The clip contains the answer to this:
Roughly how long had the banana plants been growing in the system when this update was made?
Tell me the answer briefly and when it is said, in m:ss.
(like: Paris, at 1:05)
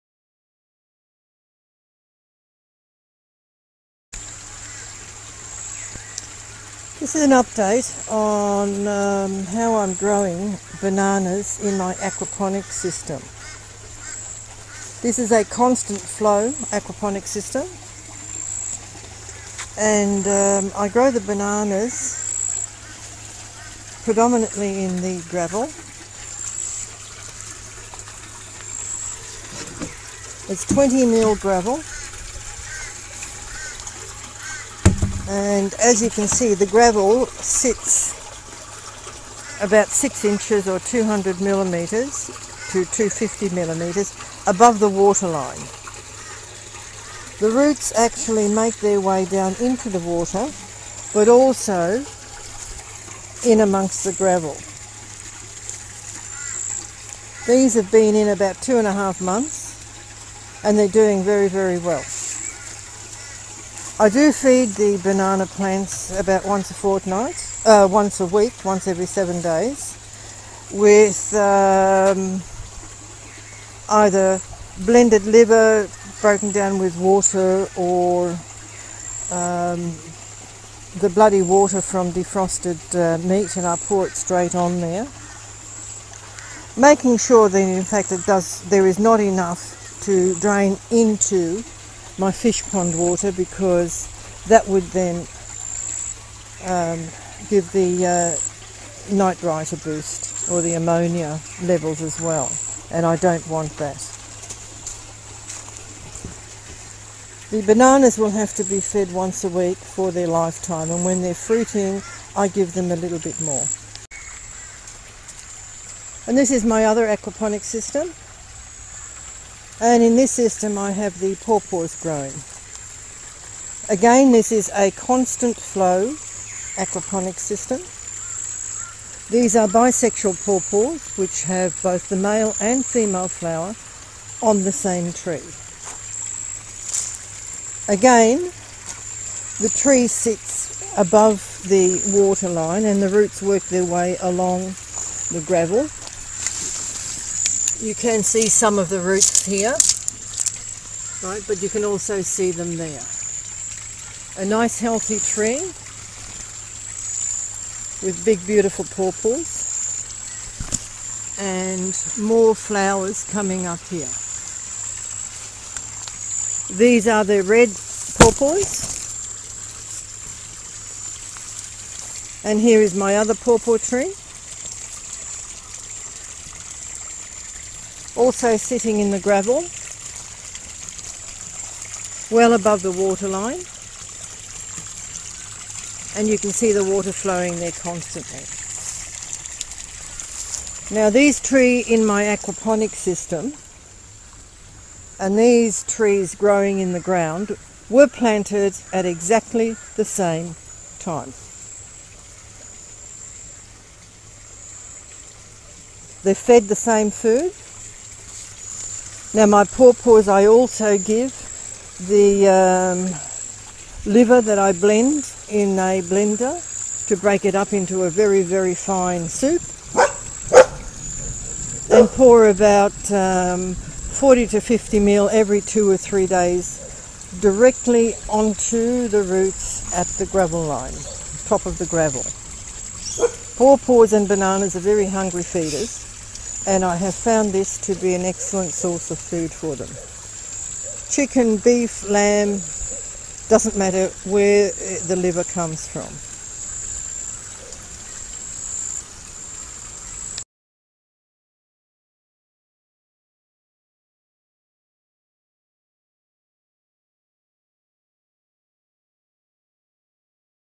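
two and a half months, at 0:58.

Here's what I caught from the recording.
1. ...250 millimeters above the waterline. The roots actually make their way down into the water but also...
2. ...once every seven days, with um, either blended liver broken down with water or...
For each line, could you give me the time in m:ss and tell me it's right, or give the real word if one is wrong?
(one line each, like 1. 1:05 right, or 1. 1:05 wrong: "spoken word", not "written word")
1. 0:42 right
2. 1:08 right.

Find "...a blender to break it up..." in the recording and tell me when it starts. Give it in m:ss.
3:35.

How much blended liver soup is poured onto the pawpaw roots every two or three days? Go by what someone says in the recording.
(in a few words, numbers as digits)
40 to 50 ml.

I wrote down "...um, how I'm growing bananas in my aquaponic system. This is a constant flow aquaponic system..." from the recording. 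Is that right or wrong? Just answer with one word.
right.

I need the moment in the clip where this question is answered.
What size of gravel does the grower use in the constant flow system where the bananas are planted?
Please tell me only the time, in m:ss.
0:30.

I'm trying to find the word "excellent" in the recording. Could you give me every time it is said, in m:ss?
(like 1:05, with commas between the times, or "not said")
3:58.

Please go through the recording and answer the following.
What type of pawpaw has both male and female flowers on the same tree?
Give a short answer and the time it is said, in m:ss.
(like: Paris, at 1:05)
bisexual, at 2:09.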